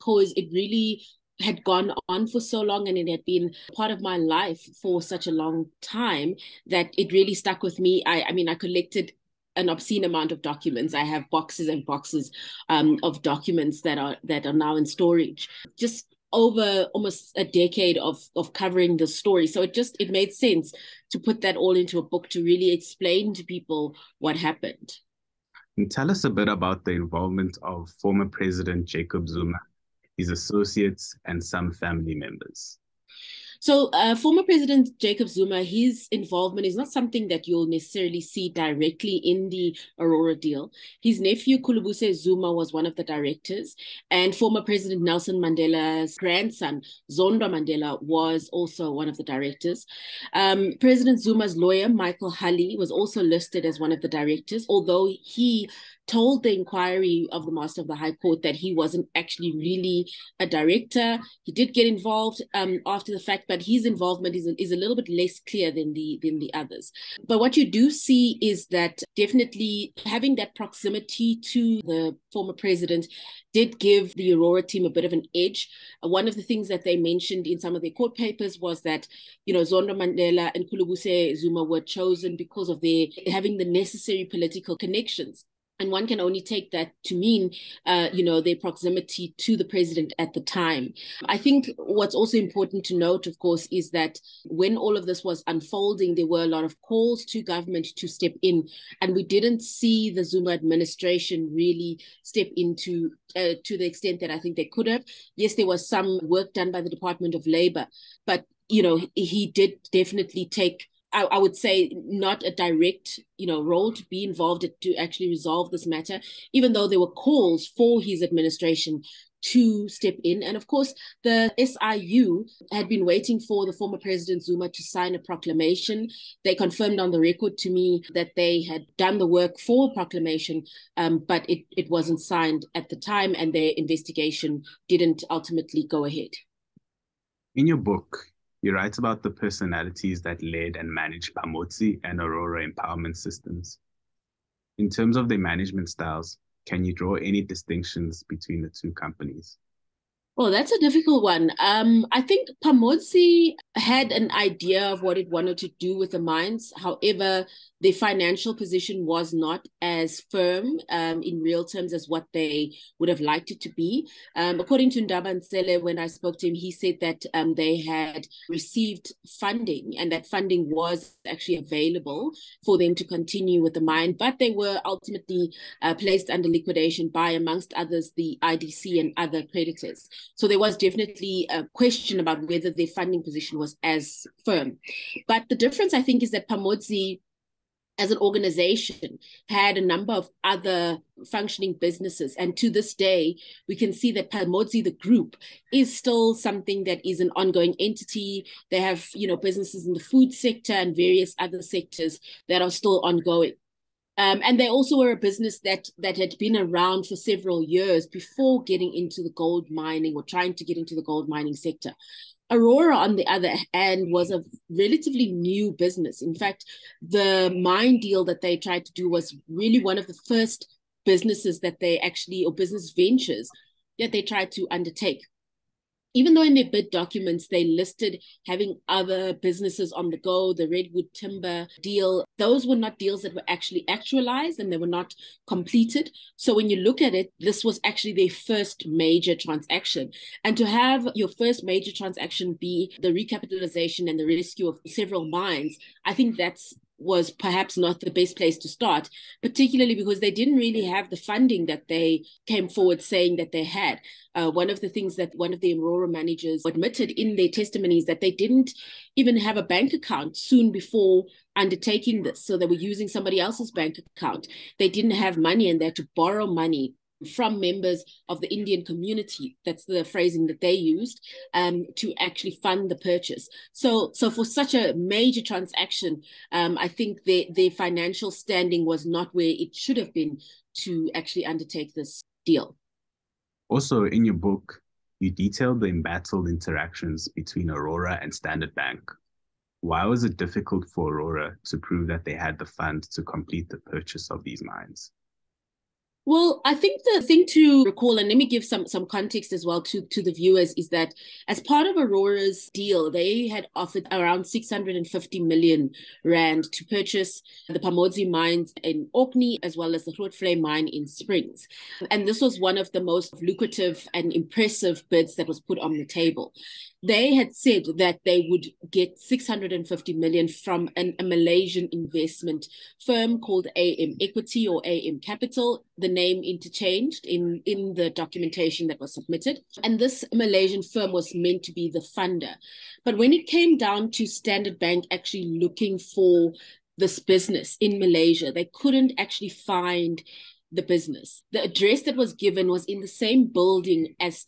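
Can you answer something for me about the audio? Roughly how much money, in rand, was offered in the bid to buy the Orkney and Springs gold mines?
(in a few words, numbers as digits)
650 million rand.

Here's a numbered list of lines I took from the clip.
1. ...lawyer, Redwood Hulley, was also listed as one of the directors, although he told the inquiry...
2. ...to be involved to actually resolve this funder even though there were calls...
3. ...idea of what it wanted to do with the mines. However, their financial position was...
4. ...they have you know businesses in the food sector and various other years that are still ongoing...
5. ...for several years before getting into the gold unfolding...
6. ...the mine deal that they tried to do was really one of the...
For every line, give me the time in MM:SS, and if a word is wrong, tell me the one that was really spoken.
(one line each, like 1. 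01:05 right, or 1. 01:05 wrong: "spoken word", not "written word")
1. 00:51 wrong: "Michael", not "Redwood"
2. 01:53 wrong: "matter", not "funder"
3. 02:34 right
4. 03:18 wrong: "sectors", not "years"
5. 03:27 wrong: "mining", not "unfolding"
6. 03:37 right.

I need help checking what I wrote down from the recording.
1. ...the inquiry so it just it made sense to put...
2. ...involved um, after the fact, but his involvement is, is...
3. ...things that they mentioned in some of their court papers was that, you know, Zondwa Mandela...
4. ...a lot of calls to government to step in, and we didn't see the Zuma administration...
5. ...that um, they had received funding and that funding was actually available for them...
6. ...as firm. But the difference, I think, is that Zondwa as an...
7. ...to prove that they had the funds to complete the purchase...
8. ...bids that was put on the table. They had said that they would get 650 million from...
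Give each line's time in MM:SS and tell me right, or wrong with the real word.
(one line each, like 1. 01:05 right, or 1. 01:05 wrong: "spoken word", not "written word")
1. 00:18 wrong: "story", not "inquiry"
2. 01:01 right
3. 01:16 right
4. 01:36 right
5. 02:46 right
6. 03:03 wrong: "Pamodzi", not "Zondwa"
7. 04:51 right
8. 05:15 right.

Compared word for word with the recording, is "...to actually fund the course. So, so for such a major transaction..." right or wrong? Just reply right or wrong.
wrong.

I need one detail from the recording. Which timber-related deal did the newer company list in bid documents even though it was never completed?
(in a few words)
Redwood Timber.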